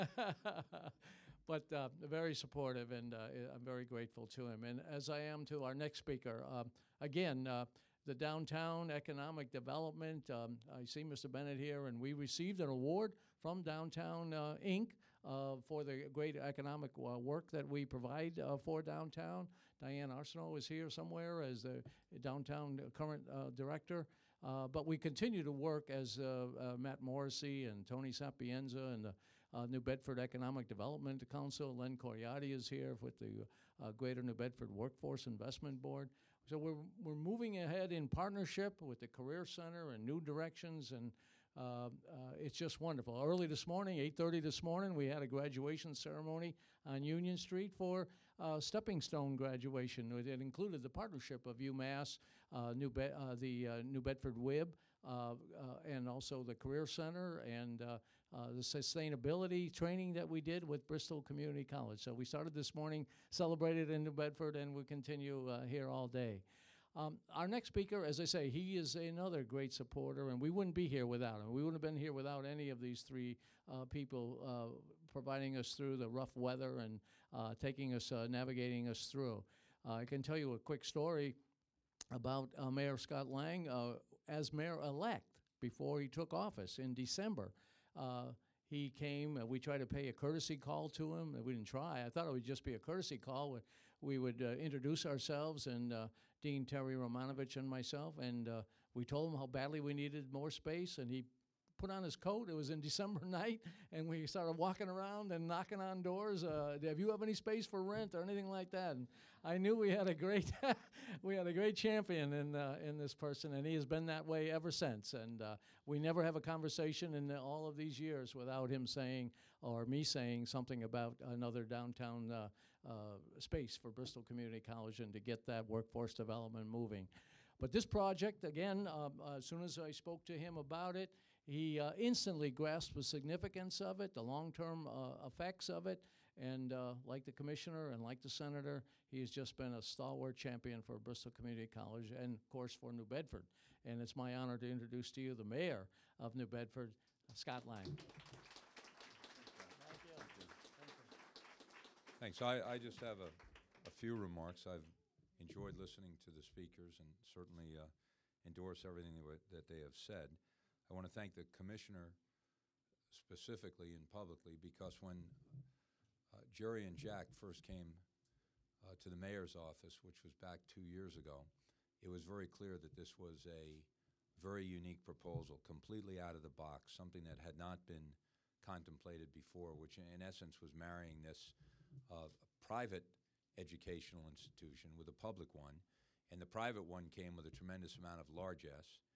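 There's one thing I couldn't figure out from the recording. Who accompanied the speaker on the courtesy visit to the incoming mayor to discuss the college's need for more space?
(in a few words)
Dean Terry Romanovich.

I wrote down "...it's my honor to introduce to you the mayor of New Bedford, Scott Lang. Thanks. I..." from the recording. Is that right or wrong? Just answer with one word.
right.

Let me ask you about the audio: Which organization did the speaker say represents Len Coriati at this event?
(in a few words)
Greater New Bedford Workforce Investment Board.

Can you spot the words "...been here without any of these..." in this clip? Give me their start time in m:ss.
1:11.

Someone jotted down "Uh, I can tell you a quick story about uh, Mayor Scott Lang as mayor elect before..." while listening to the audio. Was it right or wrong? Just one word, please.
right.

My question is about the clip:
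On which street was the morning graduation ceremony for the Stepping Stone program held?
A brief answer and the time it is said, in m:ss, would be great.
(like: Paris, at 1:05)
Union Street, at 0:47.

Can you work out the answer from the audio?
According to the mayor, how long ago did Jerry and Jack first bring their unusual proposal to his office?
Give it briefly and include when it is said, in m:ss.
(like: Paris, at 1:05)
2 years ago, at 2:50.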